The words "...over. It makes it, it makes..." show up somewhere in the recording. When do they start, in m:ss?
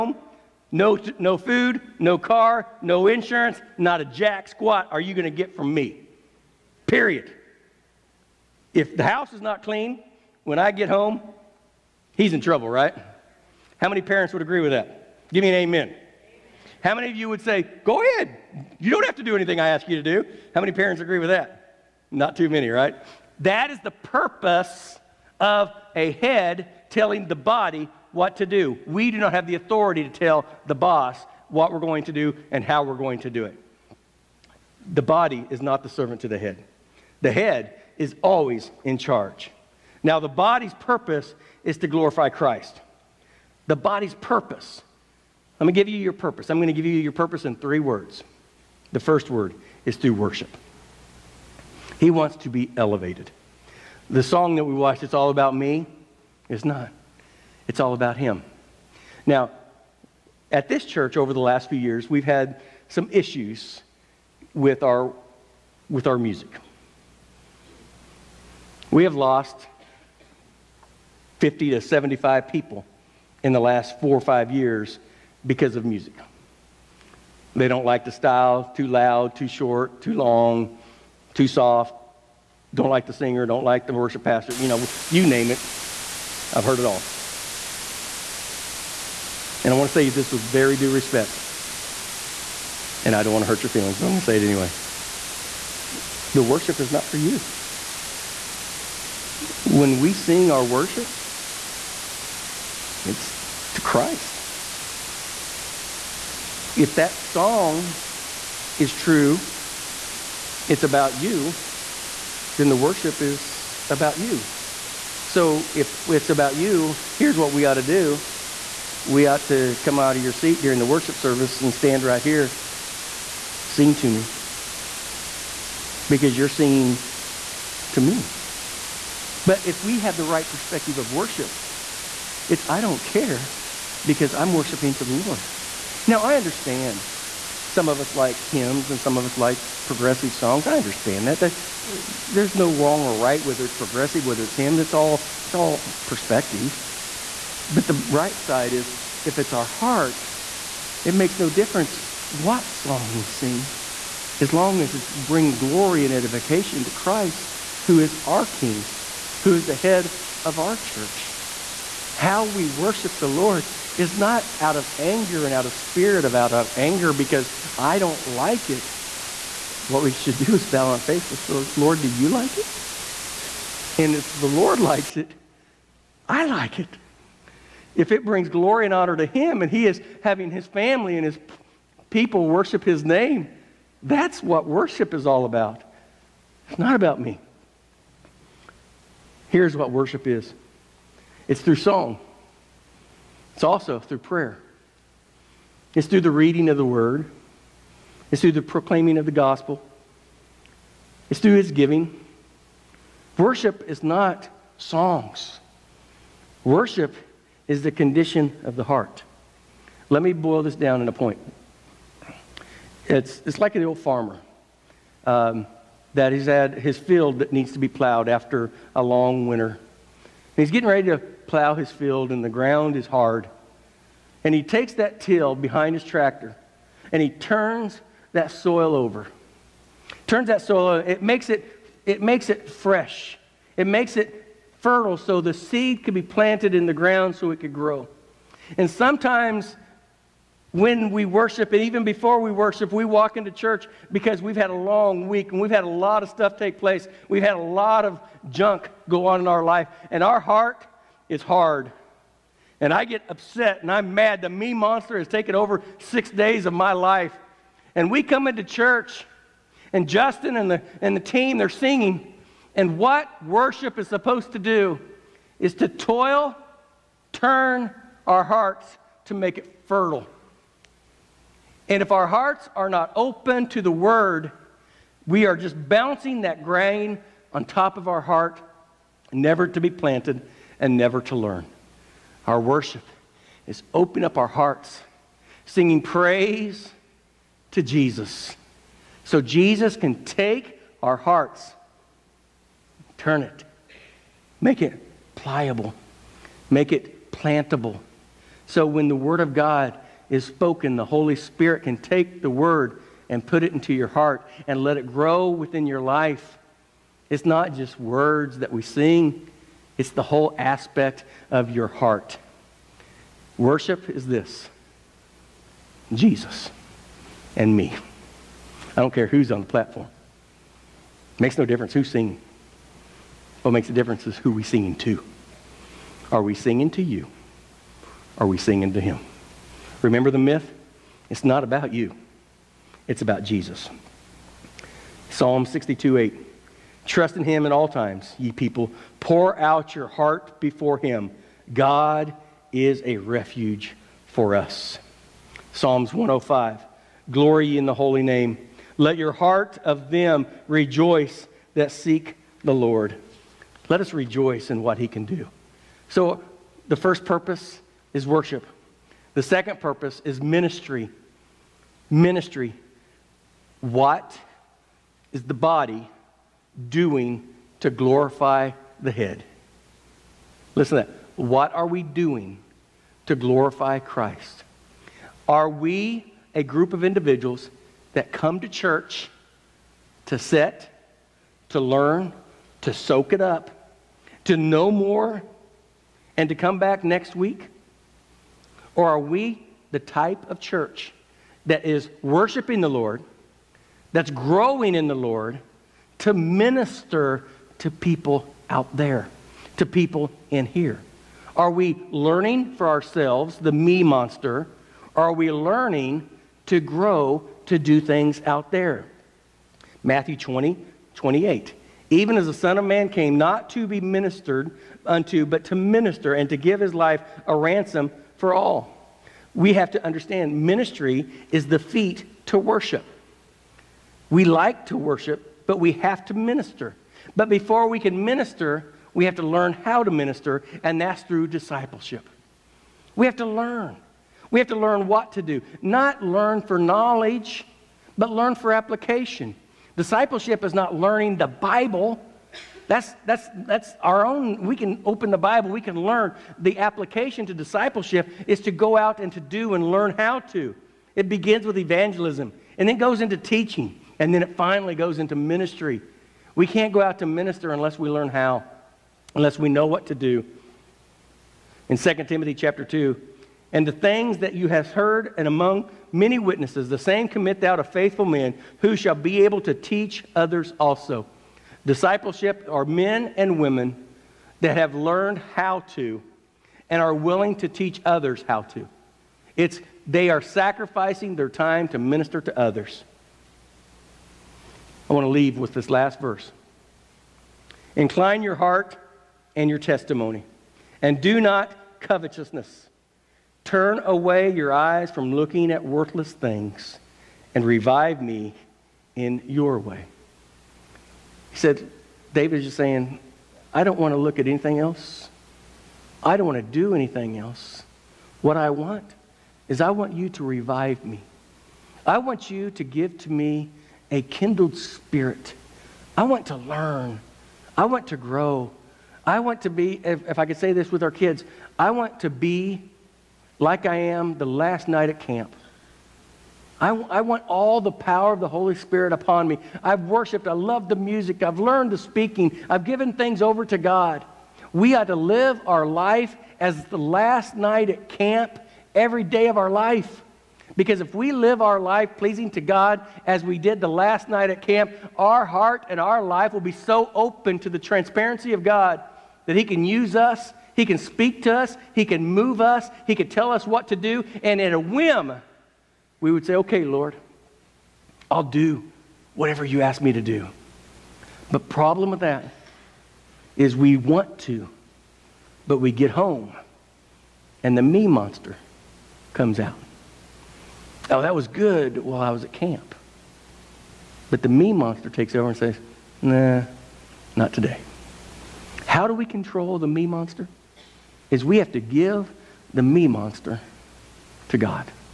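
3:50.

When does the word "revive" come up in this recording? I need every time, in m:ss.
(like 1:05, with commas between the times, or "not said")
8:17, 8:30.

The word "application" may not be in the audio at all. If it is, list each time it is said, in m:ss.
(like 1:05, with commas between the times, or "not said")
7:18, 7:26.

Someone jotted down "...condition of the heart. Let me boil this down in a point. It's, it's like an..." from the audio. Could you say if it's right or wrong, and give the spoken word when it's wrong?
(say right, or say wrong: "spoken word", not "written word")
right.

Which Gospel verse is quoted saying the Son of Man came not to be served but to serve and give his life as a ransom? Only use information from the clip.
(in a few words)
Matthew 20:28.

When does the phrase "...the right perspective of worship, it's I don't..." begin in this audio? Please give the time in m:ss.
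2:10.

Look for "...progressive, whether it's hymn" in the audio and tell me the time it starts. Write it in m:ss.
2:23.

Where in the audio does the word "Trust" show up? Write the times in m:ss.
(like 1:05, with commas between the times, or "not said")
5:37.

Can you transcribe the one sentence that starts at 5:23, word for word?
What makes a difference is who we singing to.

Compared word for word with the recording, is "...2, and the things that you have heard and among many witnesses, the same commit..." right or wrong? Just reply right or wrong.
right.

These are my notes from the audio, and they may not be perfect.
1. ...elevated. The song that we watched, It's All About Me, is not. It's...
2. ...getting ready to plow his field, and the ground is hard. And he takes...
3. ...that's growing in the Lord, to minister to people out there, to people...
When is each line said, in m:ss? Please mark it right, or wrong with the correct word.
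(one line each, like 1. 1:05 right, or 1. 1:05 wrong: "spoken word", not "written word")
1. 0:52 right
2. 3:40 right
3. 6:34 right.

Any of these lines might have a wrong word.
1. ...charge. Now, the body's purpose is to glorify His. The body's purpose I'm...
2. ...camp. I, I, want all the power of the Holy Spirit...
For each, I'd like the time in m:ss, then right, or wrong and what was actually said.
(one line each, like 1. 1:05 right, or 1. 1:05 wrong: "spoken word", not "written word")
1. 0:38 wrong: "Christ", not "His"
2. 8:45 right.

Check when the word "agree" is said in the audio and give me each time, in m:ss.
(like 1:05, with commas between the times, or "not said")
0:14, 0:20.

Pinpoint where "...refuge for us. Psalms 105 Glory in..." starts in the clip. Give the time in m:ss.
5:43.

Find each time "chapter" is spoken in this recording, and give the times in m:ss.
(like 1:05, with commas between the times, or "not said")
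7:42.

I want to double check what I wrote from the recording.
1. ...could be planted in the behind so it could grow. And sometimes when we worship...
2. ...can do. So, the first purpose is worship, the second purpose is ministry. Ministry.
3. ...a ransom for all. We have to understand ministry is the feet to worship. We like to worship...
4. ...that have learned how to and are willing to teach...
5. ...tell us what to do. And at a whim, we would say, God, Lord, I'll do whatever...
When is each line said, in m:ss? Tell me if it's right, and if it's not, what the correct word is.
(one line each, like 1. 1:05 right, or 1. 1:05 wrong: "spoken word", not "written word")
1. 3:56 wrong: "ground", not "behind"
2. 5:55 right
3. 6:57 right
4. 7:54 right
5. 9:13 wrong: "Okay", not "God".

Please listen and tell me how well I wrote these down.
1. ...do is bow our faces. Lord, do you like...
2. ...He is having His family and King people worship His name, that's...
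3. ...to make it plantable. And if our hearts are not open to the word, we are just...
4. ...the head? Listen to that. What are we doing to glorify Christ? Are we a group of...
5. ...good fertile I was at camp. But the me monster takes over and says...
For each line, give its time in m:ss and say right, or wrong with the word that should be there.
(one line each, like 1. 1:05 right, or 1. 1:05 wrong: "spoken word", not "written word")
1. 2:50 right
2. 2:59 wrong: "His", not "King"
3. 4:29 wrong: "fertile", not "plantable"
4. 6:09 right
5. 9:31 wrong: "while", not "fertile".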